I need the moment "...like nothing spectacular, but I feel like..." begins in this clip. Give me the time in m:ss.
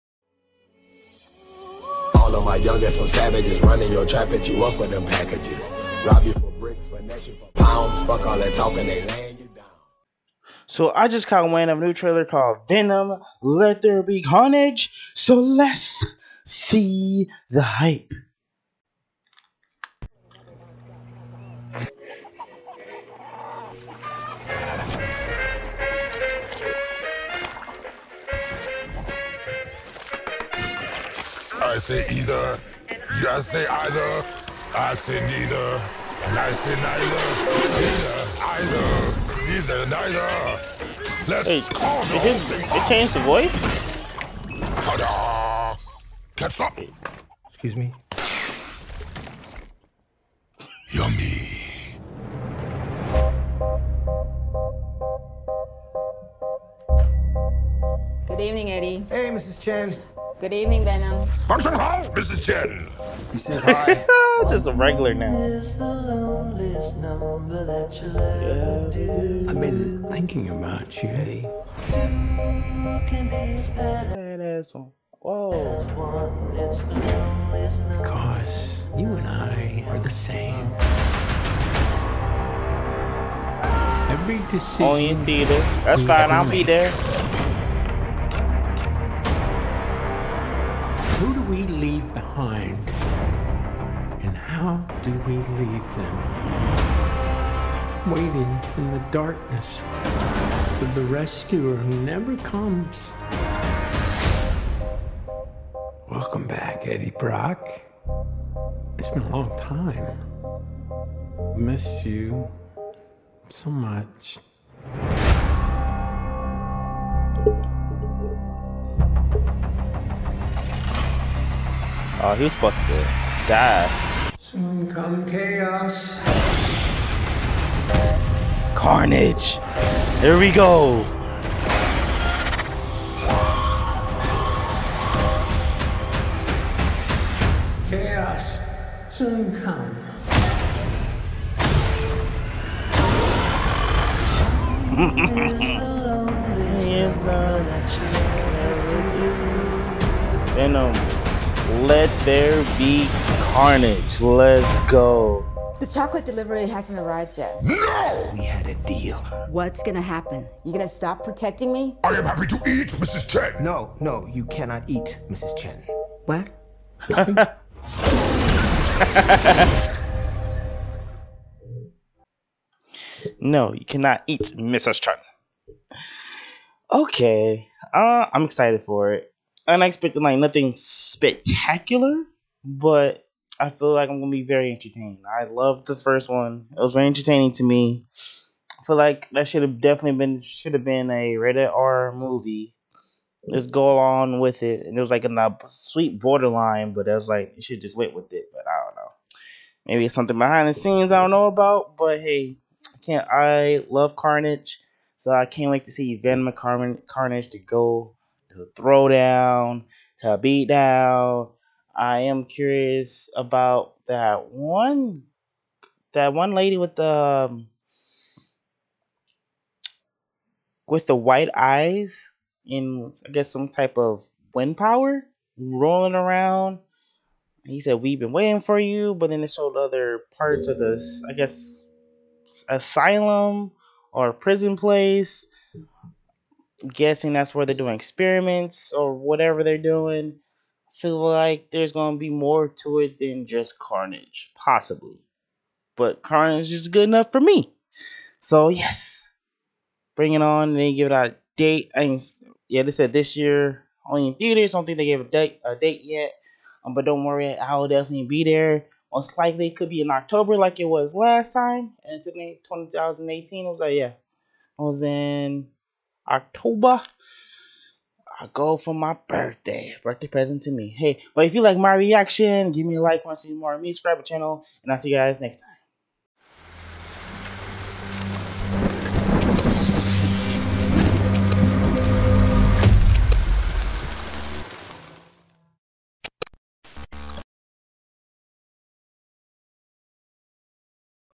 3:00.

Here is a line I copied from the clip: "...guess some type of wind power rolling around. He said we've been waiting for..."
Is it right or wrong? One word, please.
right.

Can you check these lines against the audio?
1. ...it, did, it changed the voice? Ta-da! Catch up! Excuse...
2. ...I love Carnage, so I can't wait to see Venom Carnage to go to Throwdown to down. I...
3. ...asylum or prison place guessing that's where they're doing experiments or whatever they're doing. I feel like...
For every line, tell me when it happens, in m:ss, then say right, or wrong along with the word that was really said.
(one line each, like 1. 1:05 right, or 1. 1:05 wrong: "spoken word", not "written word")
1. 0:42 right
2. 3:23 right
3. 3:52 right.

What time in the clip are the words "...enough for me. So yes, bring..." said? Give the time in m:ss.
4:07.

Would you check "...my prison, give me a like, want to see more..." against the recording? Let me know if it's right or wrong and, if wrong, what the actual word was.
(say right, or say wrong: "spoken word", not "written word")
wrong: "reaction", not "prison".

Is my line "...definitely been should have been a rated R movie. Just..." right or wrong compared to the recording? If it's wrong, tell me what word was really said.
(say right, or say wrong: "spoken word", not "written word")
right.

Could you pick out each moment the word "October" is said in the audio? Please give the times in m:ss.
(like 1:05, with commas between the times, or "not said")
4:20, 4:26.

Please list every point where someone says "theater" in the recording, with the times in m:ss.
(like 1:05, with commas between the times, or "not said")
1:25, 4:14.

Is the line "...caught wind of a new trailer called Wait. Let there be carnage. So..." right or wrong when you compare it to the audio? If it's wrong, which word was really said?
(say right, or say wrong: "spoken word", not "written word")
wrong: "Venom", not "Wait".